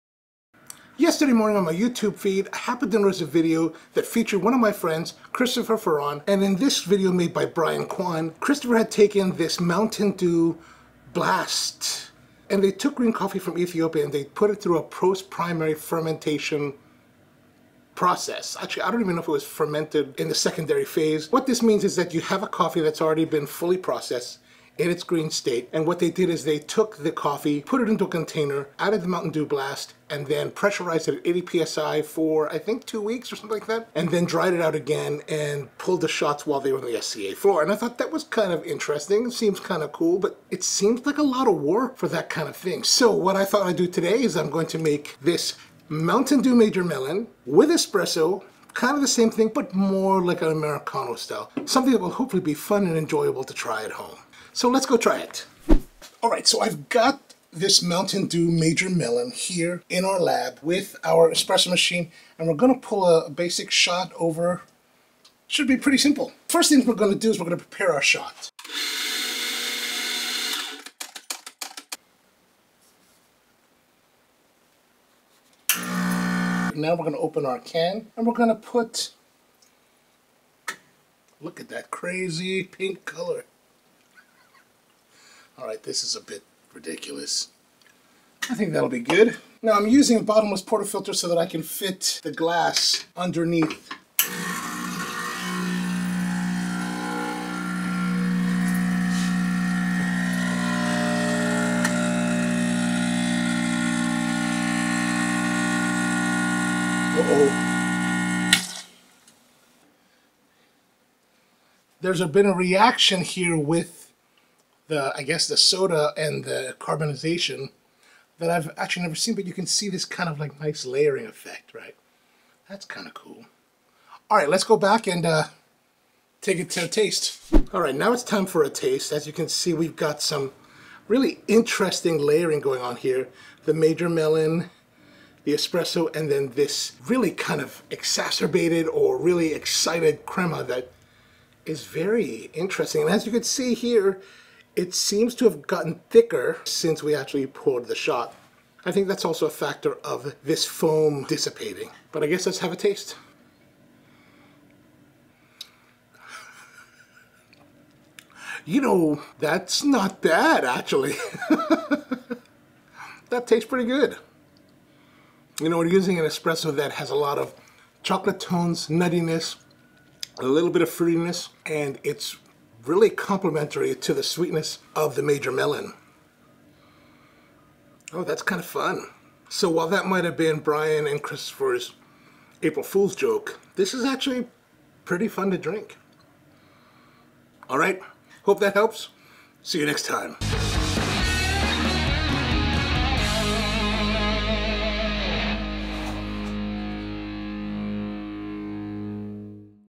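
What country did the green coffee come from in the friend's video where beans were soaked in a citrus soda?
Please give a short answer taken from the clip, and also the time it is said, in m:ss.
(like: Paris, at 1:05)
Ethiopia, at 0:13.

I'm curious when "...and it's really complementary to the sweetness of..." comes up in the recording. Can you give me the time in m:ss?
2:51.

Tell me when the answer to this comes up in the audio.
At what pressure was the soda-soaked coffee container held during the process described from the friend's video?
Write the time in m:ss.
0:31.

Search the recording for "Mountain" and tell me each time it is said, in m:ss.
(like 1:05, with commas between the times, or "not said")
0:09, 0:29, 0:45, 0:57.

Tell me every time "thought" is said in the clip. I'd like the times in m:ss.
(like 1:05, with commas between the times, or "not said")
0:37, 0:43.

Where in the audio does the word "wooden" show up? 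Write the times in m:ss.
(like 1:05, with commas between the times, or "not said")
not said.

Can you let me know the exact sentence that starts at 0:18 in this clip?
Actually, I don't even know if it was fermented in the secondary phase.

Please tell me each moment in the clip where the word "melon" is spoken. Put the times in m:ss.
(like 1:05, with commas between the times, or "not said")
0:46, 0:58, 2:14, 2:55.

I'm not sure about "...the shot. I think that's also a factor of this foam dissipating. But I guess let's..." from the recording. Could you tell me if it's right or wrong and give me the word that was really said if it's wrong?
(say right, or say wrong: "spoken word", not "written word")
right.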